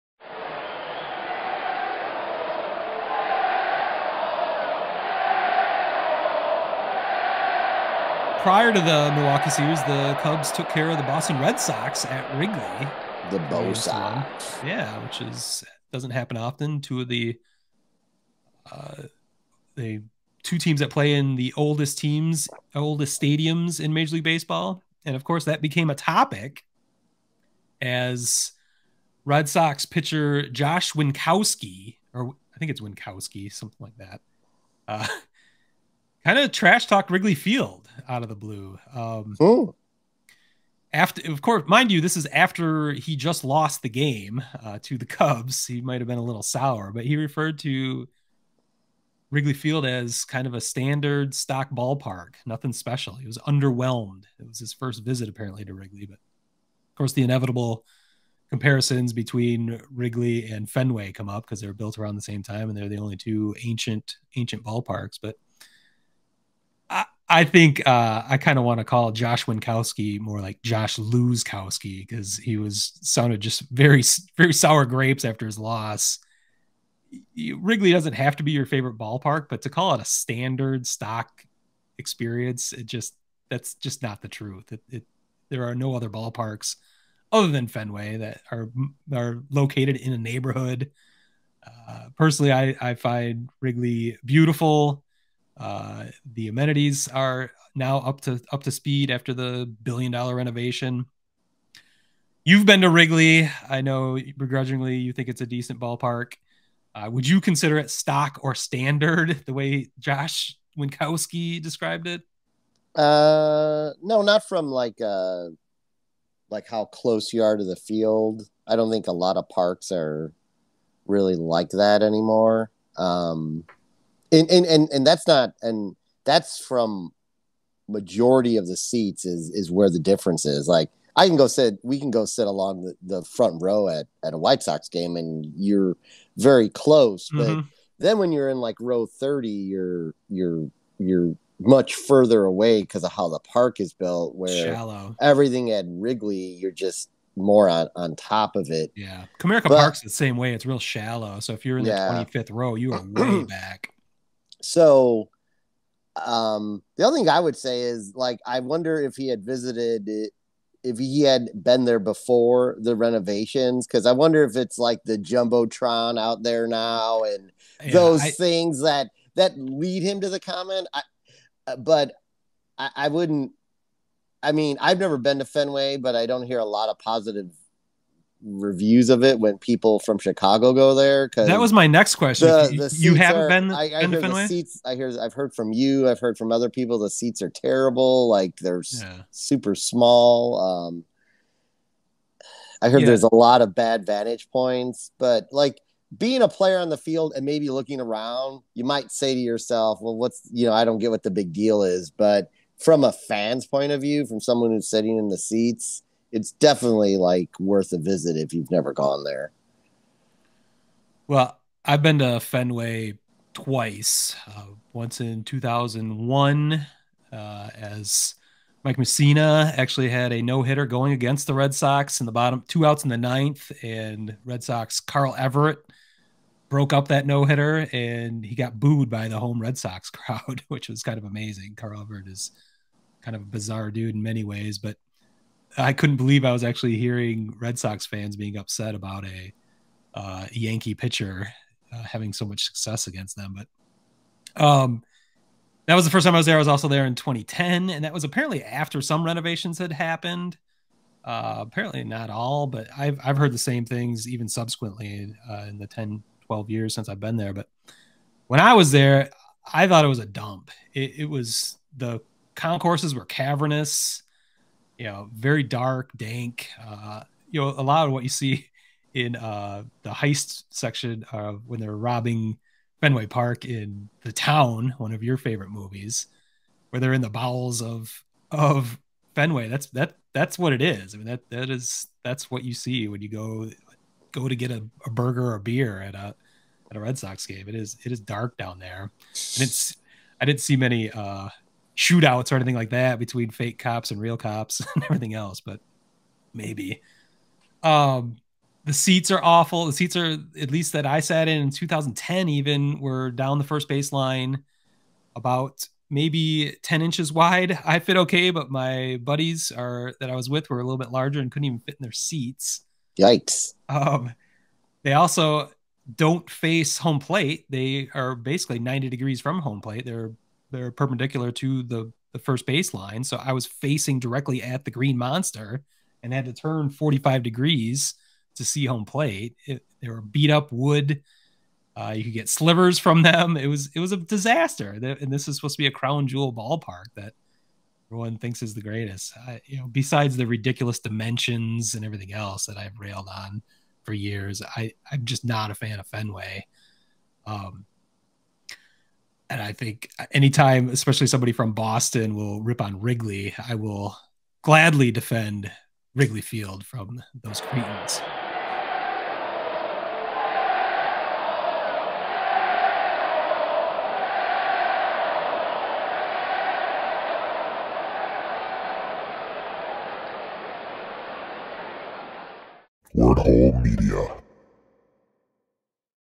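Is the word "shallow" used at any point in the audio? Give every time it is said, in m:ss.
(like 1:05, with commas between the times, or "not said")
2:24, 2:30.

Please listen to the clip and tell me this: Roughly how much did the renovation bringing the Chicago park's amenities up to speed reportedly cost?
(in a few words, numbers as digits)
billion dollar.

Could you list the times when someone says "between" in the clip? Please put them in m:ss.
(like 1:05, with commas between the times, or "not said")
0:59, 4:53.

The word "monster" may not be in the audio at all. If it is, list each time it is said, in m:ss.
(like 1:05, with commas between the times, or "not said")
5:25.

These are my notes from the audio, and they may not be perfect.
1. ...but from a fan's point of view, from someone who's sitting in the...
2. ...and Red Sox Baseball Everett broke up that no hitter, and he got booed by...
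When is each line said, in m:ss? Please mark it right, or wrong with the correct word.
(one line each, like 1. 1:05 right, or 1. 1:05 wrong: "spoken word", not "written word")
1. 3:22 right
2. 3:43 wrong: "Carl", not "Baseball".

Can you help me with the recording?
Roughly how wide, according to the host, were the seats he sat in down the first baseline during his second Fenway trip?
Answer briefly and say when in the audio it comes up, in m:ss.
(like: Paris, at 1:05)
10 inches, at 5:06.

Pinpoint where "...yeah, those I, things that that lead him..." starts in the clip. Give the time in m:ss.
2:47.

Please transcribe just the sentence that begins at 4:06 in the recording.
I was also there in 2010, and that was apparently after some renovations had happened.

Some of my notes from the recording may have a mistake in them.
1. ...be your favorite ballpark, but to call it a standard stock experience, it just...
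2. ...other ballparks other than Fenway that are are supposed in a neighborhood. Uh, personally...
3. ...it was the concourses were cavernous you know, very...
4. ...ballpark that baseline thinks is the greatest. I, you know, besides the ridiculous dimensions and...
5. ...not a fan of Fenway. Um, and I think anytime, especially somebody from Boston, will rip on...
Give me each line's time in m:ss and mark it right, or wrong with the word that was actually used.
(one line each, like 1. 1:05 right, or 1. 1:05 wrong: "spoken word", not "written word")
1. 1:18 right
2. 1:25 wrong: "located", not "supposed"
3. 4:21 right
4. 5:36 wrong: "everyone", not "baseline"
5. 5:45 right.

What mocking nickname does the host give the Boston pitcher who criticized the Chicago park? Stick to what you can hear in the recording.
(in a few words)
Josh Luzkowski.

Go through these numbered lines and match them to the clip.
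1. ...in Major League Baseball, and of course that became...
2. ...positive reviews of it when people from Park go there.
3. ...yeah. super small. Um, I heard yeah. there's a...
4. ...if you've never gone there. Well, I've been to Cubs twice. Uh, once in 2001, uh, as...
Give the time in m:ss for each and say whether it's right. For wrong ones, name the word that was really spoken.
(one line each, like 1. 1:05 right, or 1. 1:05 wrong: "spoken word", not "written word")
1. 0:23 right
2. 2:56 wrong: "Chicago", not "Park"
3. 3:08 right
4. 3:28 wrong: "Fenway", not "Cubs".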